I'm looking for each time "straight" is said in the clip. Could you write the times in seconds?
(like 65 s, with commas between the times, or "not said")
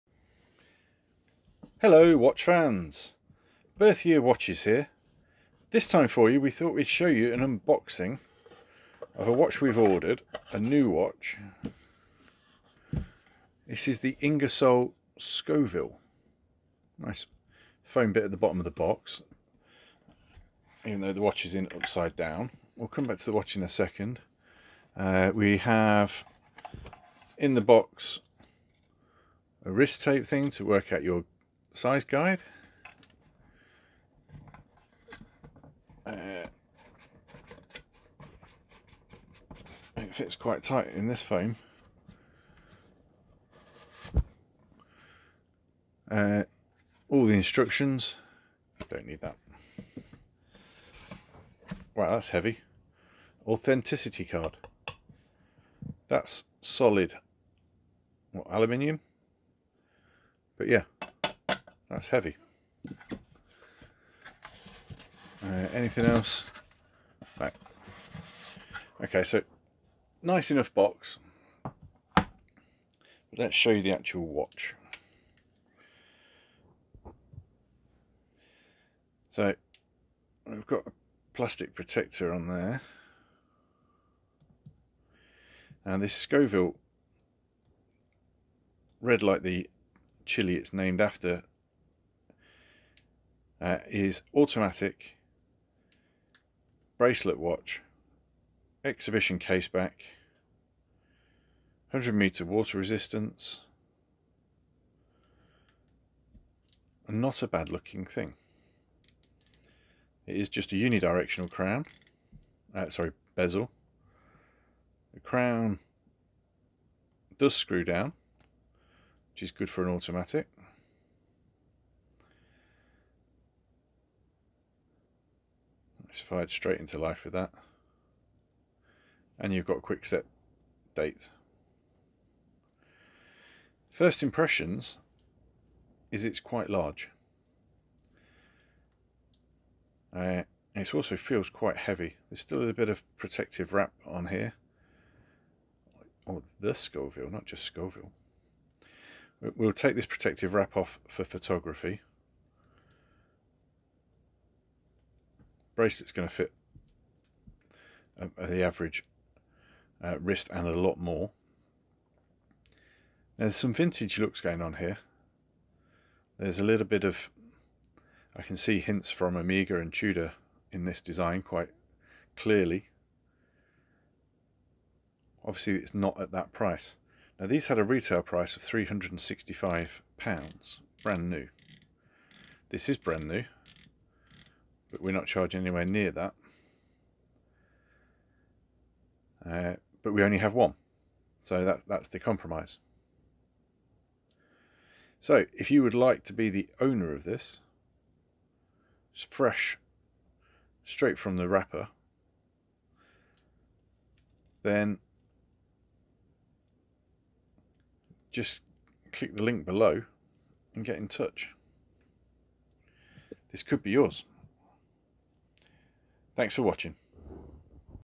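126 s, 200 s.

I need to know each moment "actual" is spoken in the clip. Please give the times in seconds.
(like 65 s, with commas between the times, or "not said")
73 s.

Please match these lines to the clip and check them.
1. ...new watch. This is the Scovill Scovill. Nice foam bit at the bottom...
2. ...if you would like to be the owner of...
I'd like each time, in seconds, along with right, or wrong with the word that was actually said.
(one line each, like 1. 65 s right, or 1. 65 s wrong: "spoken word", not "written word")
1. 10 s wrong: "Ingersoll", not "Scovill"
2. 195 s right.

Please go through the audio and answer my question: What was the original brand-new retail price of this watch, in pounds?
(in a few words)
£365.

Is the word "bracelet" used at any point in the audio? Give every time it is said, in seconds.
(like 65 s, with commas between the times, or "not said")
96 s, 155 s.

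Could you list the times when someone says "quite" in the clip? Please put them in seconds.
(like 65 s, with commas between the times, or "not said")
40 s, 136 s, 141 s, 171 s.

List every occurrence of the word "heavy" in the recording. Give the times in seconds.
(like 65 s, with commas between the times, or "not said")
52 s, 62 s, 141 s.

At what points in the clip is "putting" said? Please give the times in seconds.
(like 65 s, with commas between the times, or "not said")
not said.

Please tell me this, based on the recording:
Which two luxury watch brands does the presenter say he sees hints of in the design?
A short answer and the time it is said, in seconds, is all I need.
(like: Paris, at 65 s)
Omega and Tudor, at 169 s.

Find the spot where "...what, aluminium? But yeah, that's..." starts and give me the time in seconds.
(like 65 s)
58 s.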